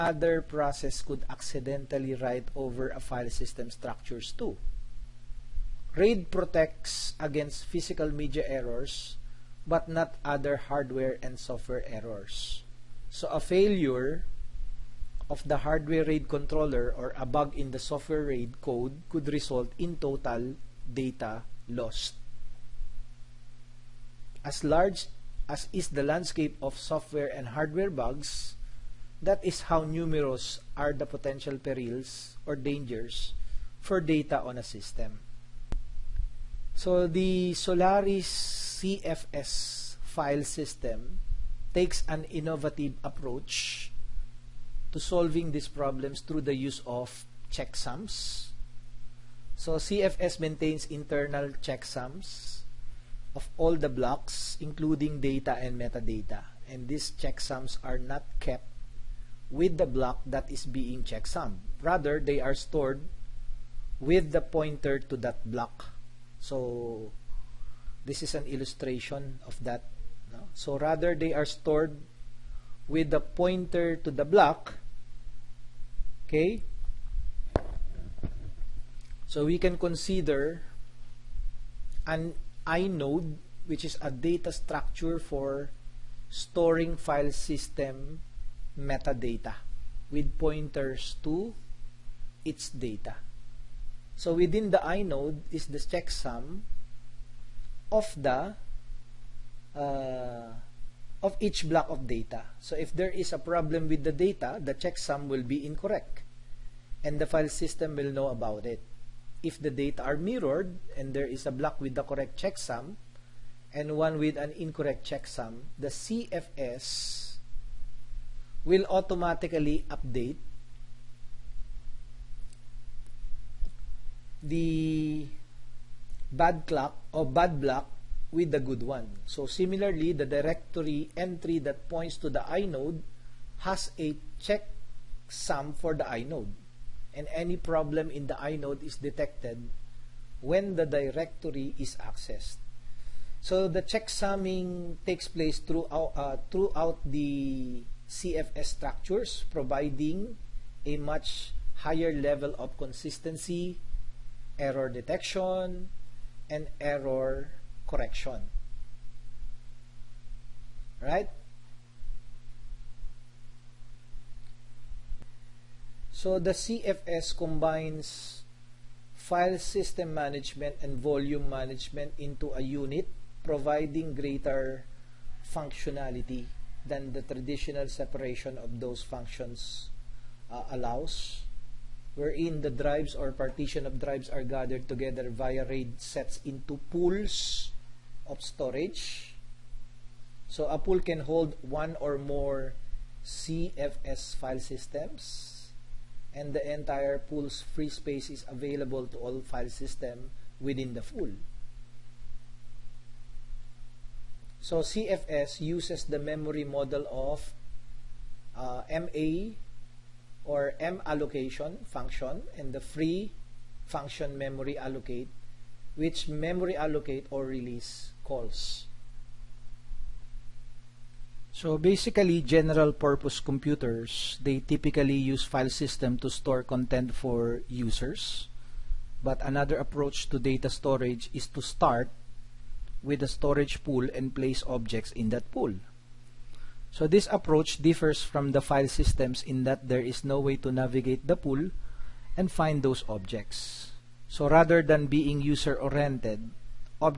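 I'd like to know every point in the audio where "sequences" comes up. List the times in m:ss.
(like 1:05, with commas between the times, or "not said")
not said.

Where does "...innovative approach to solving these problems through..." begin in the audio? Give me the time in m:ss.
0:42.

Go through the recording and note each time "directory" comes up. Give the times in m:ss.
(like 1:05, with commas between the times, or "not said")
2:10, 2:20.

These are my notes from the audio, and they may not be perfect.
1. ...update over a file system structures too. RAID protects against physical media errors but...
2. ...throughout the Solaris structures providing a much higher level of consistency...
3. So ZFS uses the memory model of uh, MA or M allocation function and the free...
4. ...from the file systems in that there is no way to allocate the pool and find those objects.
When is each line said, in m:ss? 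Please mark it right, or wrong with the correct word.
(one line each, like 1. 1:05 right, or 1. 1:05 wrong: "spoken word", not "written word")
1. 0:02 wrong: "write", not "update"
2. 2:26 wrong: "ZFS", not "Solaris"
3. 3:24 right
4. 3:58 wrong: "navigate", not "allocate".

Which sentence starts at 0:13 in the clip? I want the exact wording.
So a failure of the hardware RAID controller or a bug in the software RAID code could result in total data lost.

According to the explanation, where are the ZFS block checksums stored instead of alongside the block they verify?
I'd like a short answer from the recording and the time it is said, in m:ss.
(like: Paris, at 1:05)
with the pointer to that block, at 1:03.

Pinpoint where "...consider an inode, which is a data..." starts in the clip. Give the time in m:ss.
1:19.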